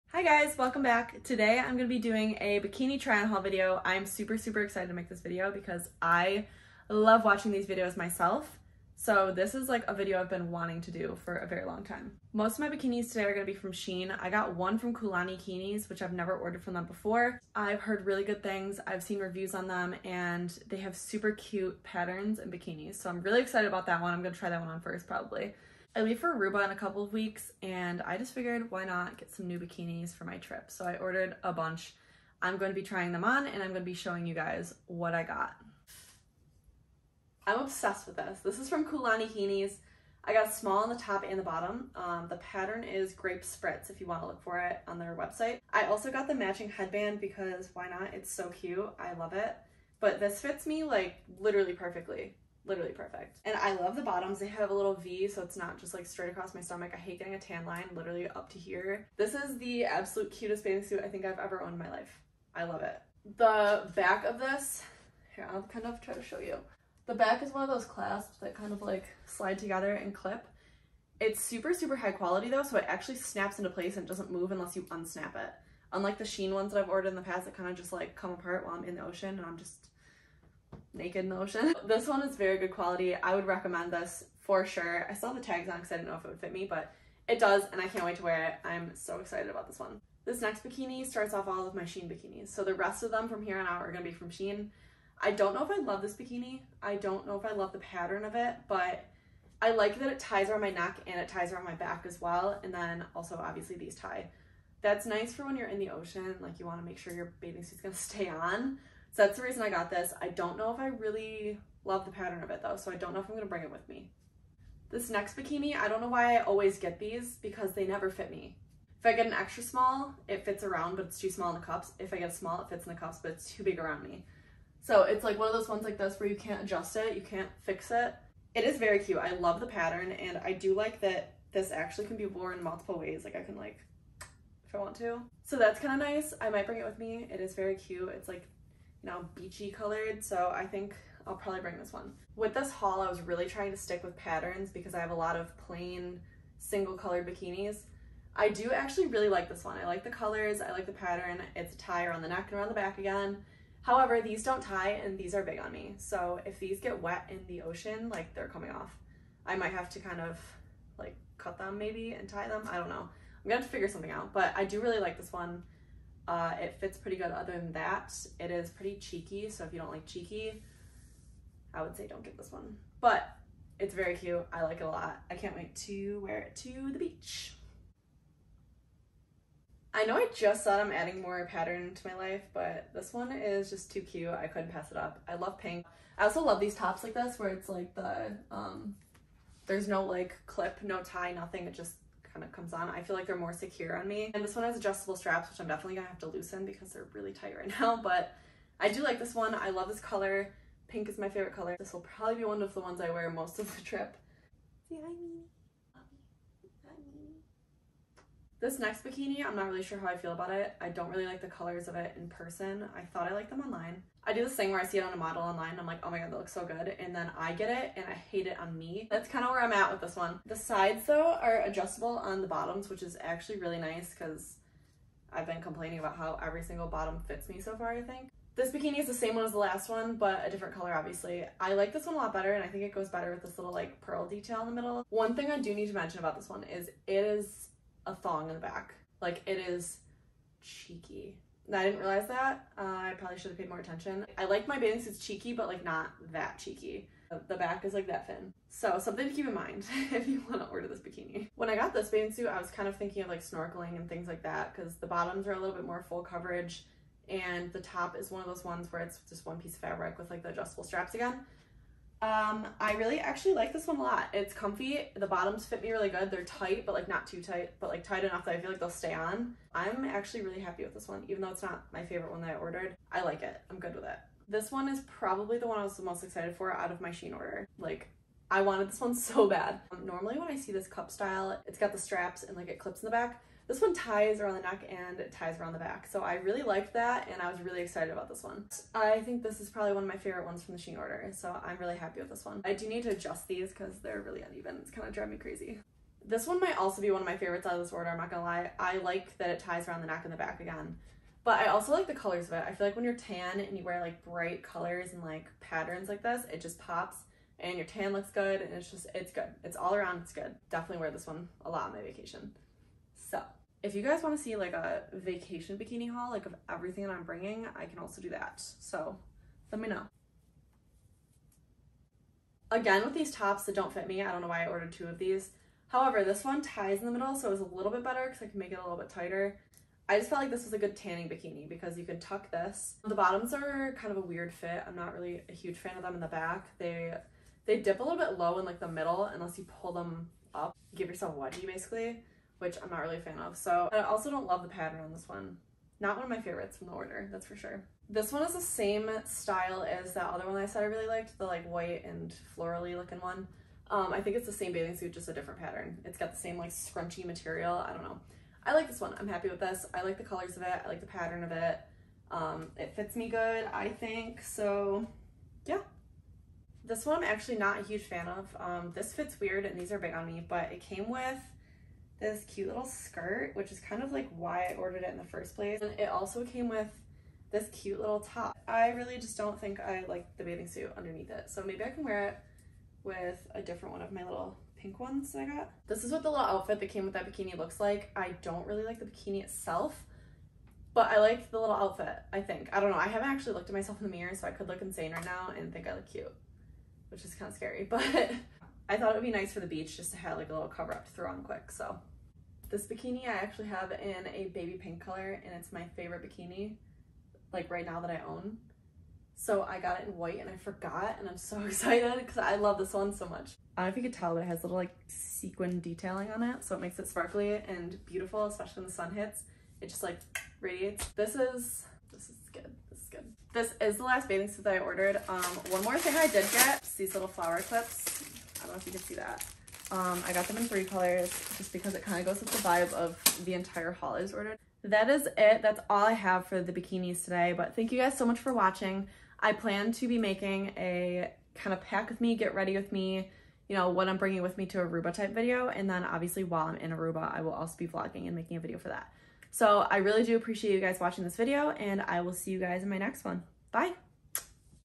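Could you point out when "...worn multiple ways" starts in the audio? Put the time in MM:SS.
02:12.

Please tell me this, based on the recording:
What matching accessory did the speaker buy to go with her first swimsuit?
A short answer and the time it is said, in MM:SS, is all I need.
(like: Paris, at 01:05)
Headband, at 00:46.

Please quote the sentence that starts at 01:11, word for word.
It's super, super high quality though, so it actually snaps into place and doesn't move unless you unsnap it.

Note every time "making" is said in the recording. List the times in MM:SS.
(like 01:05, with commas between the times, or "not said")
07:20, 07:28.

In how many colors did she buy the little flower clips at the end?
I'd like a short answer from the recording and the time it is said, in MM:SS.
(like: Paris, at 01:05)
3, at 07:10.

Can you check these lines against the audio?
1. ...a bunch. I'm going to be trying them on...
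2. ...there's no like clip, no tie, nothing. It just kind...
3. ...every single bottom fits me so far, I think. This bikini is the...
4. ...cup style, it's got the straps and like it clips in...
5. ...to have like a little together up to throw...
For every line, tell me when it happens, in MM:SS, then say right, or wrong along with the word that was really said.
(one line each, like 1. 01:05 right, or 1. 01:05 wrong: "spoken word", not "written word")
1. 00:31 right
2. 03:09 right
3. 03:46 right
4. 04:40 right
5. 06:40 wrong: "cover", not "together".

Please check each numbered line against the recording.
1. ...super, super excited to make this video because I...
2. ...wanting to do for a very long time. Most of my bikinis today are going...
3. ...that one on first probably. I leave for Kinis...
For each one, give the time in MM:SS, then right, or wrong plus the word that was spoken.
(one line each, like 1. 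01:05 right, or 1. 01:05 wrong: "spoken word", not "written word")
1. 00:04 right
2. 00:10 right
3. 00:24 wrong: "Aruba", not "Kinis".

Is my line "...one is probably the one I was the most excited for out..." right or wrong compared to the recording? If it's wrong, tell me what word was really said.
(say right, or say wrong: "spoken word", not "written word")
right.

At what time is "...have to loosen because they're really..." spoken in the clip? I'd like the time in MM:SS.
03:16.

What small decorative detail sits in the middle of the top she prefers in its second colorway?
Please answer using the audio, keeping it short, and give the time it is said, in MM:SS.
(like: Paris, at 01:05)
Pearl detail, at 03:54.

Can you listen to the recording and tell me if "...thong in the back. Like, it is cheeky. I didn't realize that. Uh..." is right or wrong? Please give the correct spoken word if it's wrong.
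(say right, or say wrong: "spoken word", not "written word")
right.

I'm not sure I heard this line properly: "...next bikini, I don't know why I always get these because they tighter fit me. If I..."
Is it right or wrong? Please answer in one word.
wrong.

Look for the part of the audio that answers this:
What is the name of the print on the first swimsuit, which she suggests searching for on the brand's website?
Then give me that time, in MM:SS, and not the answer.
00:43.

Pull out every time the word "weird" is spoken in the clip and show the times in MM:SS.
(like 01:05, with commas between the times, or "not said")
05:34, 06:09.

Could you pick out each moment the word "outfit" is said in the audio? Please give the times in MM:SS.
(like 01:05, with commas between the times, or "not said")
06:26, 06:31.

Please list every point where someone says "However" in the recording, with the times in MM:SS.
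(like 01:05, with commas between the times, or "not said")
02:33, 05:25.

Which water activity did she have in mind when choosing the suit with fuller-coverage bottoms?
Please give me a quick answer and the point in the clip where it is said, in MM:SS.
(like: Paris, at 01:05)
Snorkeling, at 04:13.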